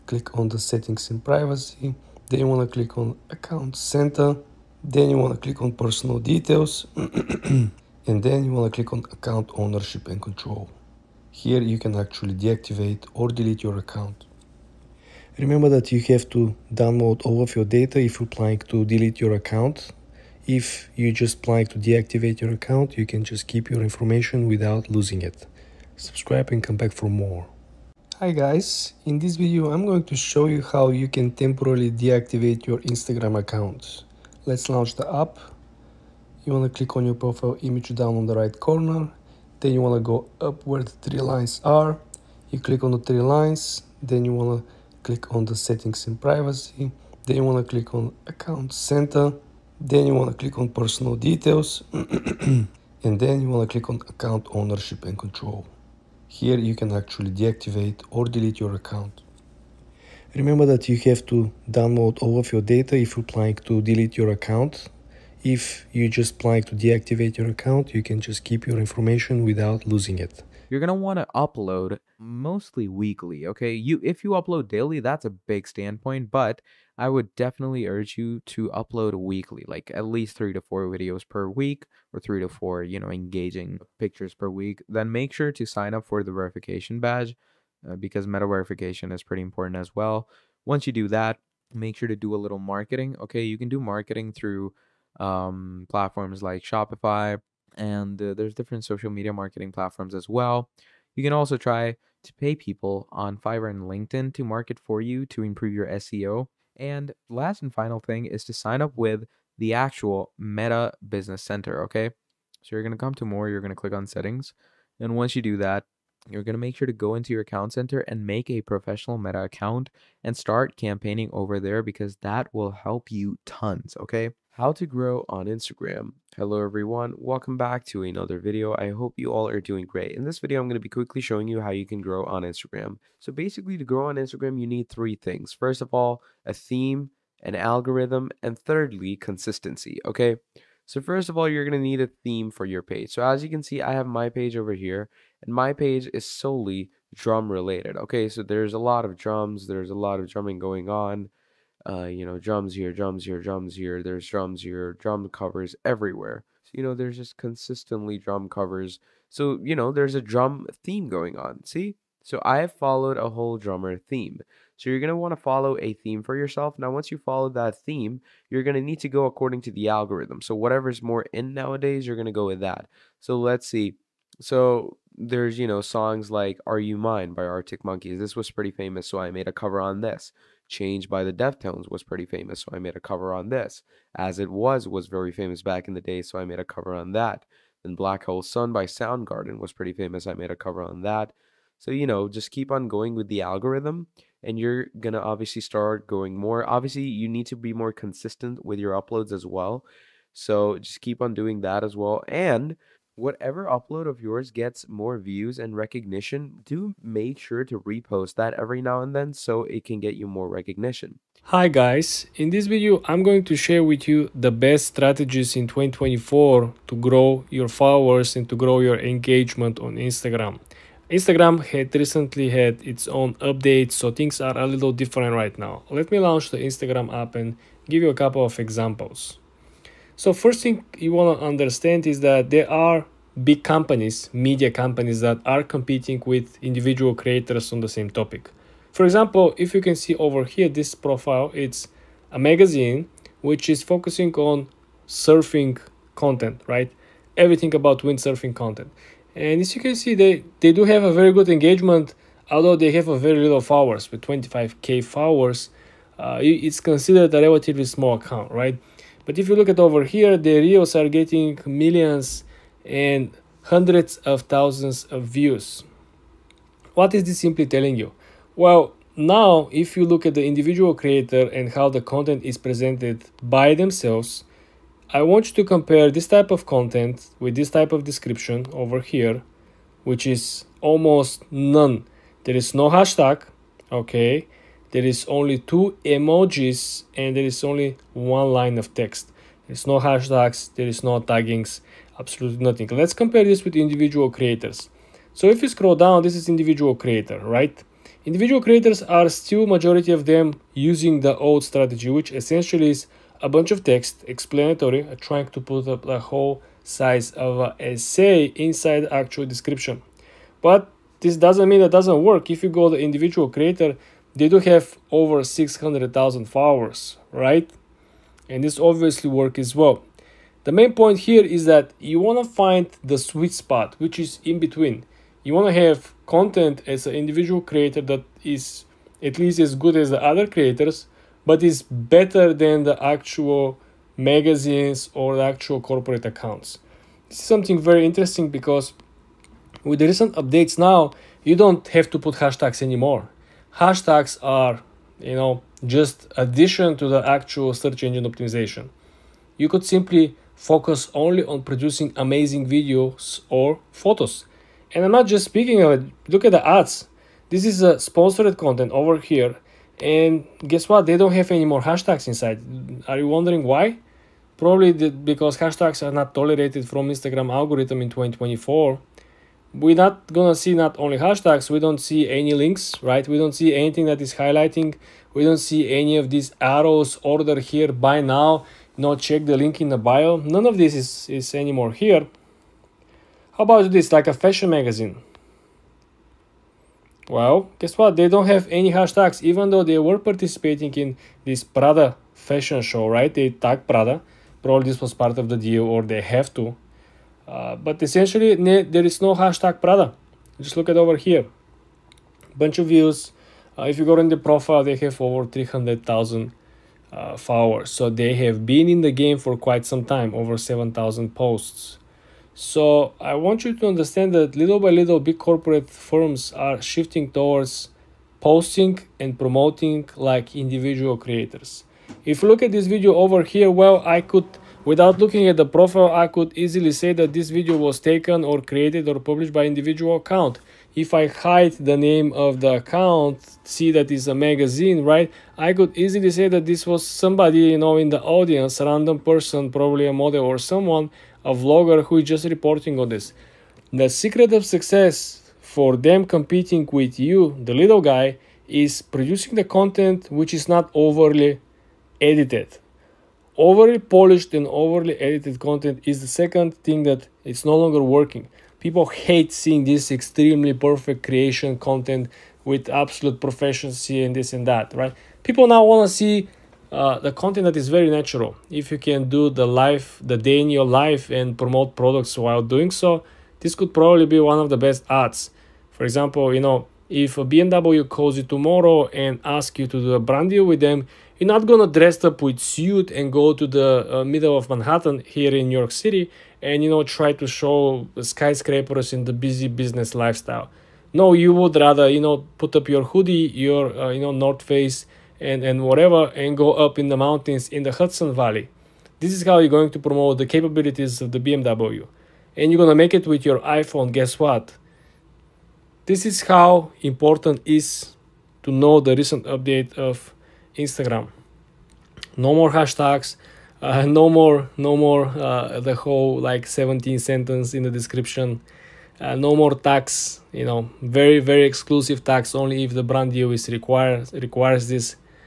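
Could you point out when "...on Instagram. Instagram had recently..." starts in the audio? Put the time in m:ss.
3:39.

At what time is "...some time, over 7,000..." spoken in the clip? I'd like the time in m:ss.
6:49.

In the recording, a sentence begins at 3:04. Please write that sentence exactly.
As It Was was very famous back in the day, so I made a cover on that.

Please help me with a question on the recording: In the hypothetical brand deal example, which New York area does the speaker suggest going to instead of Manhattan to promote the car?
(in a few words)
Hudson Valley.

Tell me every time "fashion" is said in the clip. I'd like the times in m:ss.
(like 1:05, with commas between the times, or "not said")
6:24, 6:32.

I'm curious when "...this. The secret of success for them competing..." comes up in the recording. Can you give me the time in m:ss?
7:23.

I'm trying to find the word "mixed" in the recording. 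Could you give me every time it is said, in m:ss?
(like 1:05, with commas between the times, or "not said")
not said.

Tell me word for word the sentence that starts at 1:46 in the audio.
And last and final thing is to sign up with the actual Meta Business Center, okay?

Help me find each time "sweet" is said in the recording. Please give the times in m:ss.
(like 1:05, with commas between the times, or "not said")
5:23.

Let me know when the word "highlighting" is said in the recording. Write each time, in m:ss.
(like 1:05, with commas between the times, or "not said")
6:14.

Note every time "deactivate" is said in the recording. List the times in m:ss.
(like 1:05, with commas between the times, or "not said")
0:12, 0:21, 0:31, 0:57, 1:06.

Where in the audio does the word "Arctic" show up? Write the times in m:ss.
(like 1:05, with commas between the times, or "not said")
2:57.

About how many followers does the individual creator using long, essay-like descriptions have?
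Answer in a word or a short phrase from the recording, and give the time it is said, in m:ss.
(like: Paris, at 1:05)
600,000, at 5:15.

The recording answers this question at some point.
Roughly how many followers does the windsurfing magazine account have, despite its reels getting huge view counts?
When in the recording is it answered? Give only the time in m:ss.
4:14.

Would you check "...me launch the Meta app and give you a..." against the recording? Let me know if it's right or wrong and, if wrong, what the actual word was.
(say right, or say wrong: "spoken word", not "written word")
wrong: "Instagram", not "Meta".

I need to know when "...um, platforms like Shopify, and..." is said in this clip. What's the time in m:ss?
1:35.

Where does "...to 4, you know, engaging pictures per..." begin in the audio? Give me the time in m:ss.
1:22.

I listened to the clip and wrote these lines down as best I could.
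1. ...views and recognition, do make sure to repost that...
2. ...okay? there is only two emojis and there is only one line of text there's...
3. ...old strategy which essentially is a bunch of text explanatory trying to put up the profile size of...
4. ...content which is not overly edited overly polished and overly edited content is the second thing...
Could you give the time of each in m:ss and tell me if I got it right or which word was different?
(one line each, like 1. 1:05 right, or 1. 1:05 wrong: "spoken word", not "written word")
1. 3:25 right
2. 4:43 right
3. 5:01 wrong: "whole", not "profile"
4. 7:29 right.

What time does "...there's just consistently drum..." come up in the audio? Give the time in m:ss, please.
2:36.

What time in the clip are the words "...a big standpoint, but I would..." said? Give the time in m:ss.
1:15.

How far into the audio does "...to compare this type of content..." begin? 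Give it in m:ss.
4:35.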